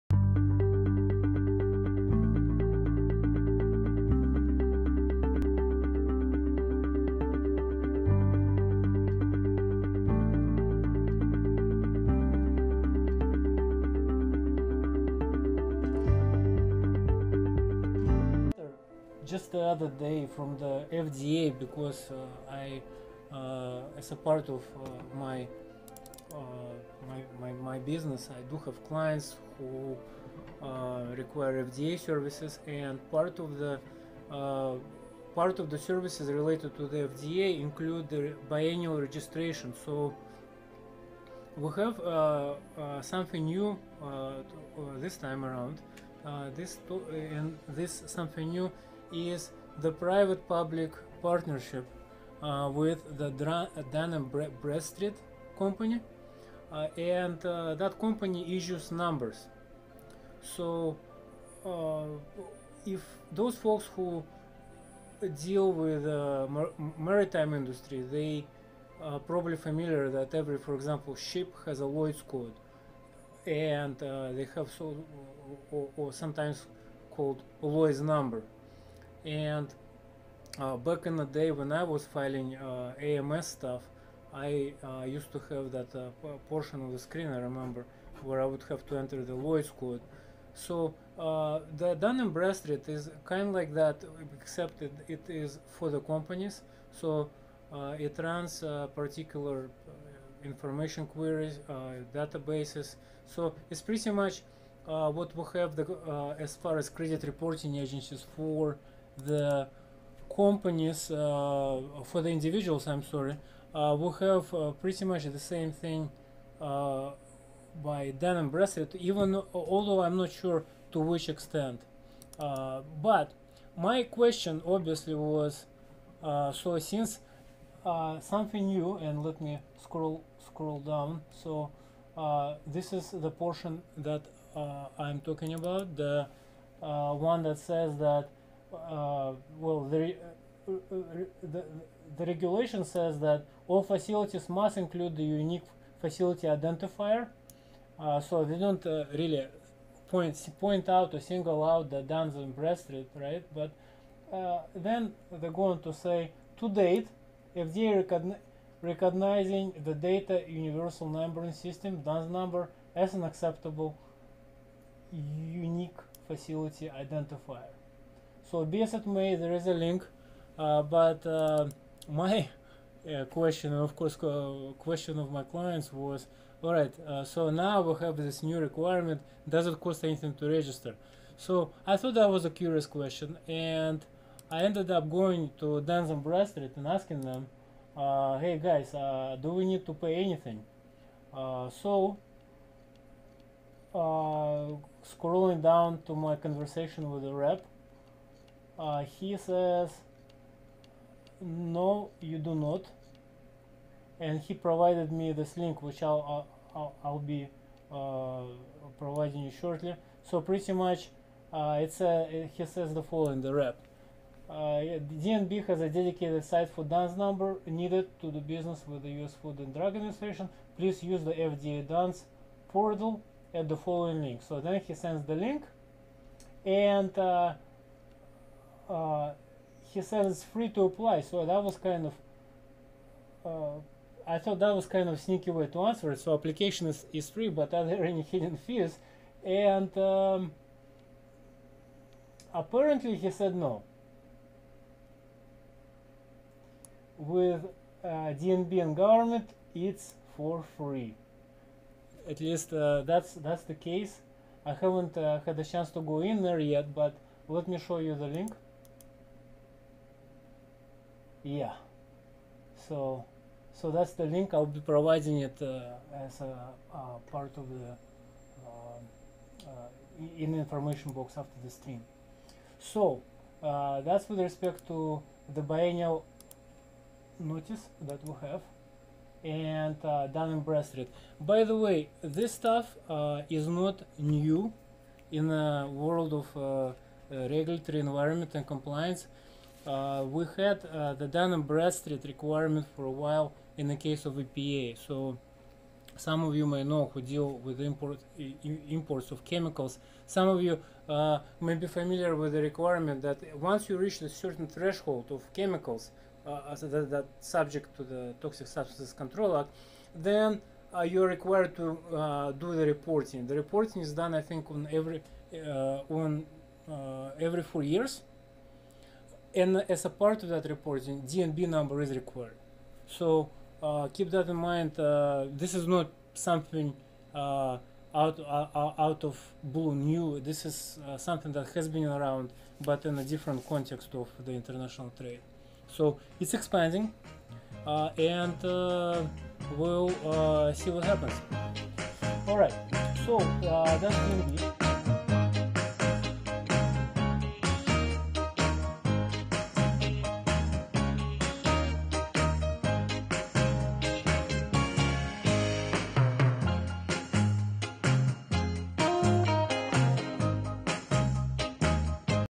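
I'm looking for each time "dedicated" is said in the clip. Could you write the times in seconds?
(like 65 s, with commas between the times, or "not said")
215 s.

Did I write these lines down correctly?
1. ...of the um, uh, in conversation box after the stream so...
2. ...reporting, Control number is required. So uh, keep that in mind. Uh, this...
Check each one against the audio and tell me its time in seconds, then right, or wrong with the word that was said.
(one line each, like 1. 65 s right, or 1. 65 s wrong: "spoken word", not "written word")
1. 267 s wrong: "information", not "conversation"
2. 320 s wrong: "DNB", not "Control".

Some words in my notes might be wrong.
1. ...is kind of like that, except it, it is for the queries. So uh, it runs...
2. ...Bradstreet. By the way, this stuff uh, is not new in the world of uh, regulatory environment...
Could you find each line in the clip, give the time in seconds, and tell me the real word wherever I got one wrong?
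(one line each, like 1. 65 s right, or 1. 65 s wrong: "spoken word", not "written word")
1. 92 s wrong: "companies", not "queries"
2. 280 s right.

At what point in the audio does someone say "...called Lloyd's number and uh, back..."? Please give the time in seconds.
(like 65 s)
77 s.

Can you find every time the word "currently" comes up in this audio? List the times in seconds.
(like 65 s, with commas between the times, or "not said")
not said.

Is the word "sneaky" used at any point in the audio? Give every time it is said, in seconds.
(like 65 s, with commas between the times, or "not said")
235 s.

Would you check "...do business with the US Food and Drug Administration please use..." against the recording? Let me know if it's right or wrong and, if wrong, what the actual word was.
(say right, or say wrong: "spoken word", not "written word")
right.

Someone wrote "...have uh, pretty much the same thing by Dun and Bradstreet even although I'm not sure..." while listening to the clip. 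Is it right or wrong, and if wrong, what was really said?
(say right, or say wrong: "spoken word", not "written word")
right.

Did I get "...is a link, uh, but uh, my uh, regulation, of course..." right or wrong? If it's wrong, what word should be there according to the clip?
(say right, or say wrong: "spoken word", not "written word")
wrong: "question", not "regulation".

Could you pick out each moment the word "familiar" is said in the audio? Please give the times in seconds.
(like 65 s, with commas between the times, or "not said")
69 s, 301 s.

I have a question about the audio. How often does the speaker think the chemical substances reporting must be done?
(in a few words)
every 4 years.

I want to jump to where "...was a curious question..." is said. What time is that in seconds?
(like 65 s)
182 s.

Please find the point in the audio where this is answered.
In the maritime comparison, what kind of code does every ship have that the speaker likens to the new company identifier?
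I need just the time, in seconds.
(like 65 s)
71 s.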